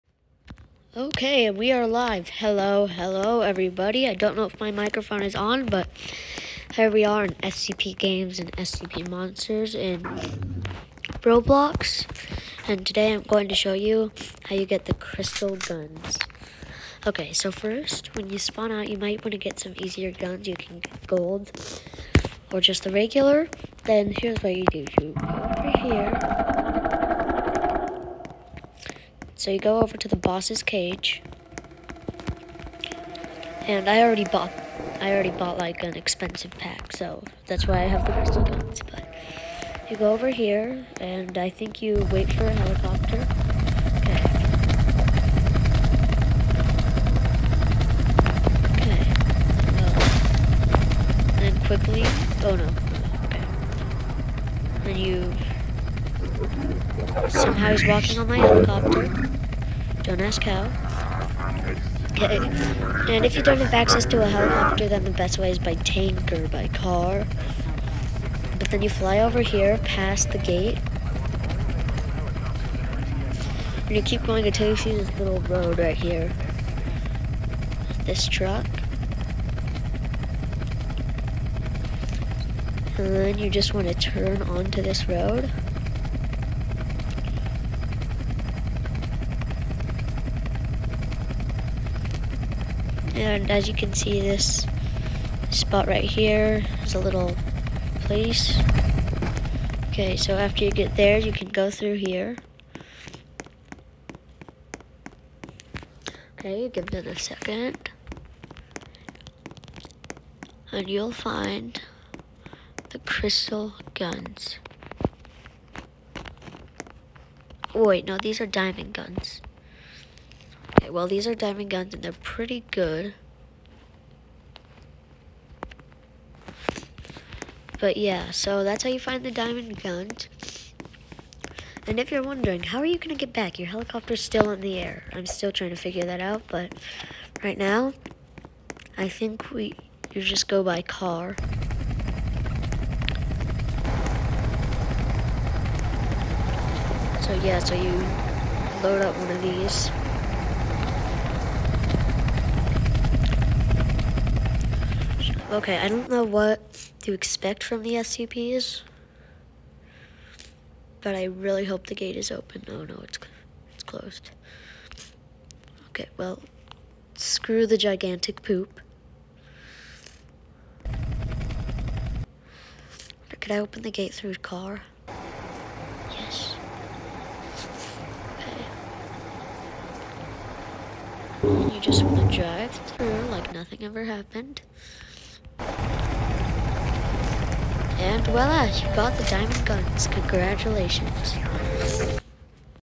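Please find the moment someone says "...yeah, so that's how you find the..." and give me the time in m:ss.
2:07.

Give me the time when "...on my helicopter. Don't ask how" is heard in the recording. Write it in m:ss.
0:58.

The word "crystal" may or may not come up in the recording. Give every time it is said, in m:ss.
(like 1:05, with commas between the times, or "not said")
0:14, 0:38, 1:52.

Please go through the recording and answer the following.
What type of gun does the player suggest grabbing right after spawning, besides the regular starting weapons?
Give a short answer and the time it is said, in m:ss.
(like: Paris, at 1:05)
Gold, at 0:21.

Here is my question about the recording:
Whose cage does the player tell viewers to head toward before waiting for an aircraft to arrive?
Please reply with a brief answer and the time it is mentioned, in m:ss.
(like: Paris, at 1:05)
The boss's, at 0:30.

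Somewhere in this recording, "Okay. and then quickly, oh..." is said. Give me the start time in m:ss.
0:48.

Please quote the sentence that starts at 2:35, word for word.
Okay, I don't know what to expect from the SCPs, but I really hope the gate is open.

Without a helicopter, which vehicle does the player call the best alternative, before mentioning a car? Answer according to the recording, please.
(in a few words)
Tank.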